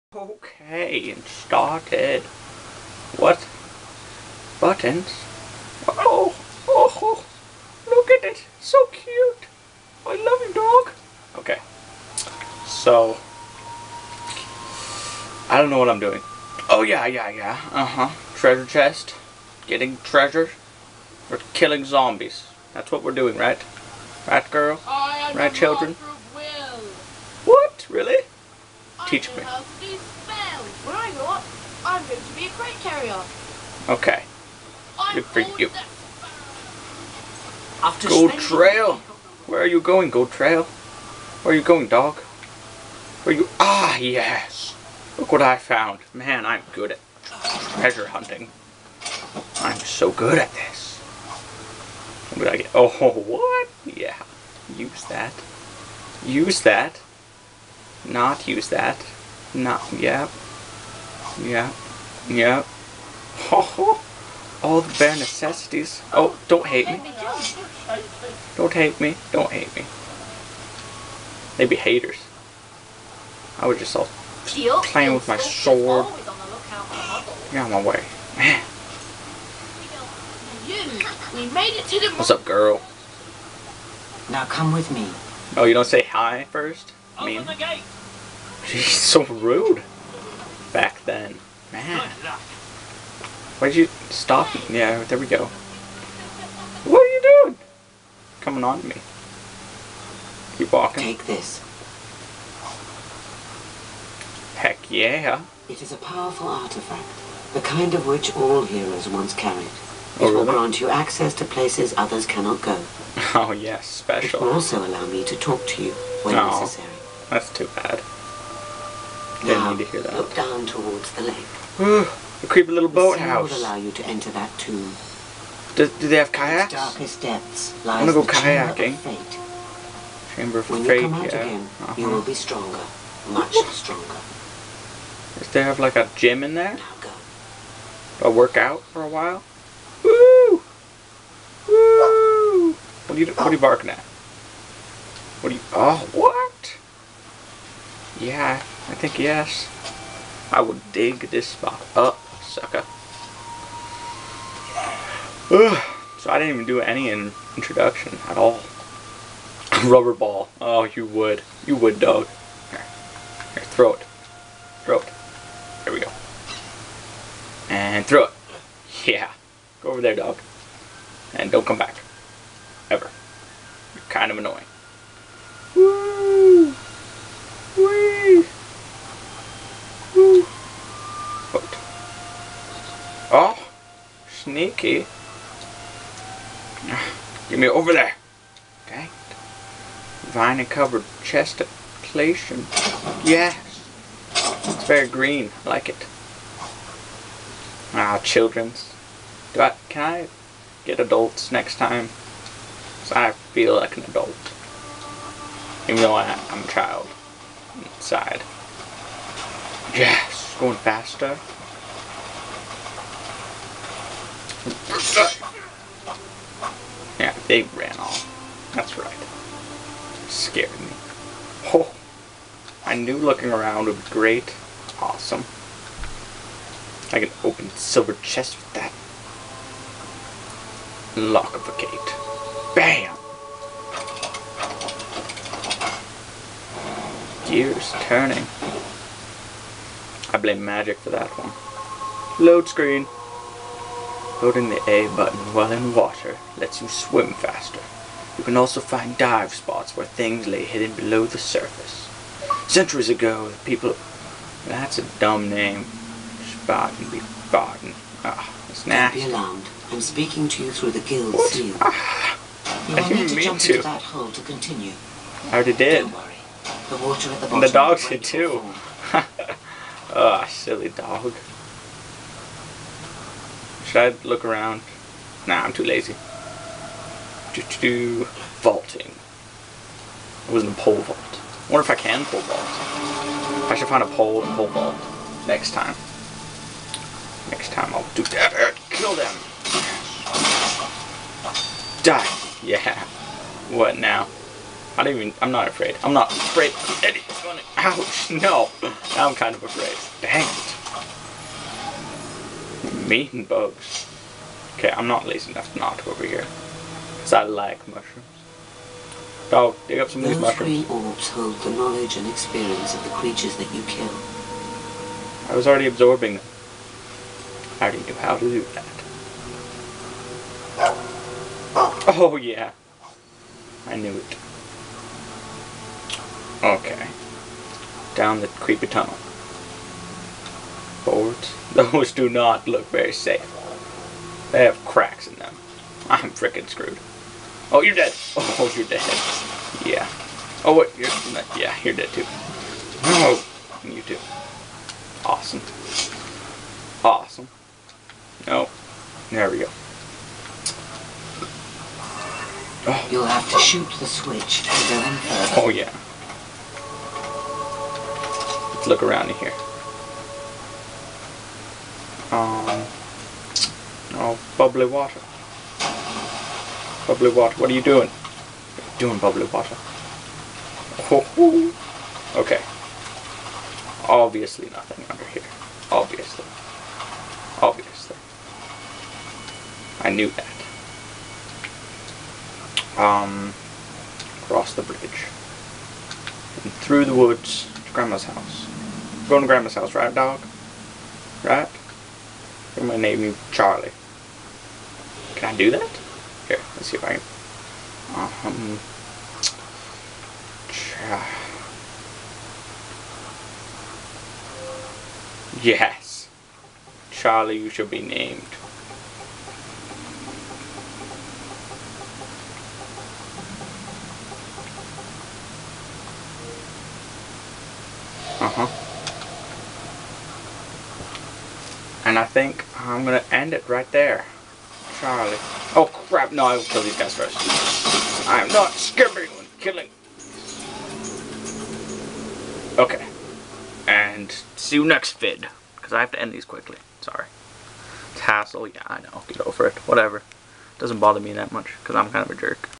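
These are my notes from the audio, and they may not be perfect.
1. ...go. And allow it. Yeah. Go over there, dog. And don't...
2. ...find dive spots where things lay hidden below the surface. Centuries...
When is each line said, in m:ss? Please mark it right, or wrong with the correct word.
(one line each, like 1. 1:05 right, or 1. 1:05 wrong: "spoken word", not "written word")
1. 2:45 wrong: "throw", not "allow"
2. 4:08 right.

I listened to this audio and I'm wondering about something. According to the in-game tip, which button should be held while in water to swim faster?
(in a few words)
A button.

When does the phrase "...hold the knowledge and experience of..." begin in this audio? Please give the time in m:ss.
5:11.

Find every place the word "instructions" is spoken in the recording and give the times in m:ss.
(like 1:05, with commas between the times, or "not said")
not said.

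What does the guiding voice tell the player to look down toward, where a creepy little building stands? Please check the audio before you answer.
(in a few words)
The lake.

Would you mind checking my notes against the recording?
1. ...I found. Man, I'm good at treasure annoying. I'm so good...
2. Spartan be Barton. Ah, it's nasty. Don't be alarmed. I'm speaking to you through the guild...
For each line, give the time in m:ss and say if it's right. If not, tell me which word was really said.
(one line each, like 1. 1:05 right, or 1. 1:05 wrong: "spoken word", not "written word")
1. 0:45 wrong: "hunting", not "annoying"
2. 4:16 right.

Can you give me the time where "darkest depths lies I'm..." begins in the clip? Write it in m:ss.
2:06.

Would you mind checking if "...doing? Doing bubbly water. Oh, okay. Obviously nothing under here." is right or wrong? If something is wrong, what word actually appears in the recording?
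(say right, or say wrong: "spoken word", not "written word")
right.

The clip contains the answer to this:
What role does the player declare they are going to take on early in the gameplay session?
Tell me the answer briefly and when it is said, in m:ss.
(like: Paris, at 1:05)
Crate carrier, at 0:32.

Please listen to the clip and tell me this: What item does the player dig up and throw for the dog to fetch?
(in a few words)
Rubber ball.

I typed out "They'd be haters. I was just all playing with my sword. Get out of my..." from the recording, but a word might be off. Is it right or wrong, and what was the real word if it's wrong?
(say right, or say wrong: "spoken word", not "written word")
right.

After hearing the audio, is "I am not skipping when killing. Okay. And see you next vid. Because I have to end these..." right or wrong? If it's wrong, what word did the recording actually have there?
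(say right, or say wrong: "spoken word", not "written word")
right.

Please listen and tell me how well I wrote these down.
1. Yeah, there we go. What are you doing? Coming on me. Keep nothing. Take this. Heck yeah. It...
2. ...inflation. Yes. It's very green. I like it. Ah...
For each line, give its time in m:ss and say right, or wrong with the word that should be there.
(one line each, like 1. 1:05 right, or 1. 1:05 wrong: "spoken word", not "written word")
1. 1:34 wrong: "walking", not "nothing"
2. 3:11 right.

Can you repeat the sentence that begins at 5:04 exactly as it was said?
Okay, I'm not lazy enough to not go over here.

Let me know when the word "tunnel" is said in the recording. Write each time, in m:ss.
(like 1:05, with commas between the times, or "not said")
5:28.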